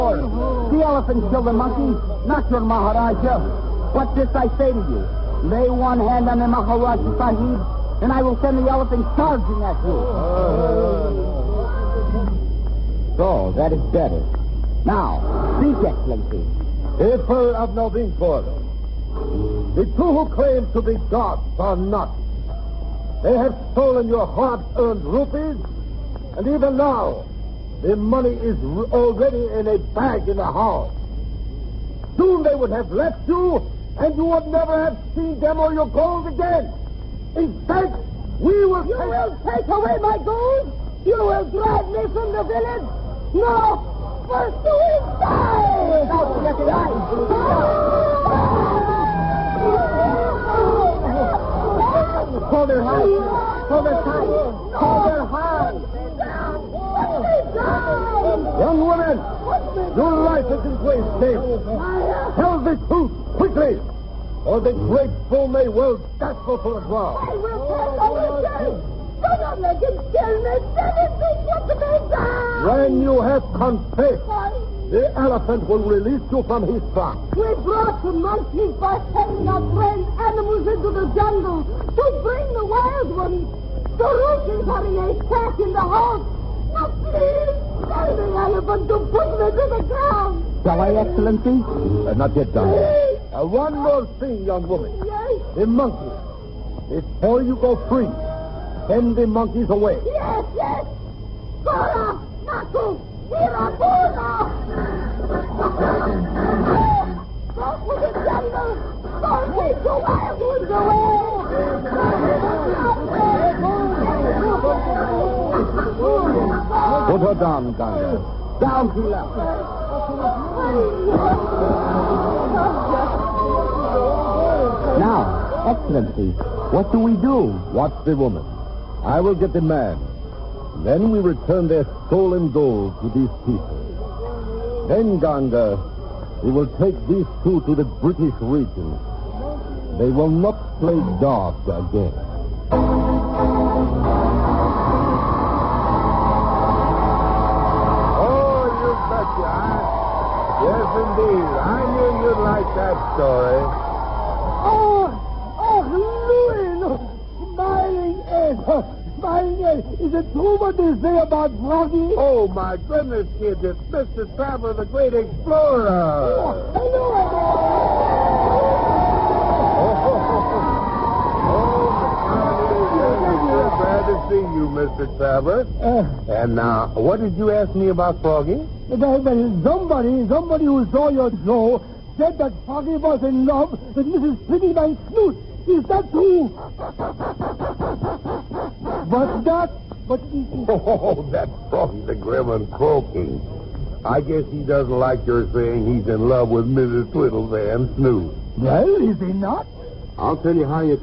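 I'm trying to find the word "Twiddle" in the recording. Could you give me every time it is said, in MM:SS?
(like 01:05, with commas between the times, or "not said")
03:04, 03:17.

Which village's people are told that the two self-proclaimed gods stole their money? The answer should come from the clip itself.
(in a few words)
Novinpur.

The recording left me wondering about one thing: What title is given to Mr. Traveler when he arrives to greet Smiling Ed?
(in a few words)
The great explorer.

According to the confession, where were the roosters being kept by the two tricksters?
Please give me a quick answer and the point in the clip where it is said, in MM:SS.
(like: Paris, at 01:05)
In a sack, at 01:24.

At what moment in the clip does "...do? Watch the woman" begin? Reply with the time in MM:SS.
02:07.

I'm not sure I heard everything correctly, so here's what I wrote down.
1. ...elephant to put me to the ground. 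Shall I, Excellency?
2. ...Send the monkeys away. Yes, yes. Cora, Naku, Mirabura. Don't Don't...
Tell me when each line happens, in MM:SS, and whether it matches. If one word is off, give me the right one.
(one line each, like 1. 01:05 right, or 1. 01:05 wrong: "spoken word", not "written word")
1. 01:28 right
2. 01:38 right.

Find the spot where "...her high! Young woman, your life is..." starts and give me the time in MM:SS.
00:55.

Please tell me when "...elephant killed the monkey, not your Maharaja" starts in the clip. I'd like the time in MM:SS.
00:00.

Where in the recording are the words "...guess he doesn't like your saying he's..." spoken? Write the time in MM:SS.
03:14.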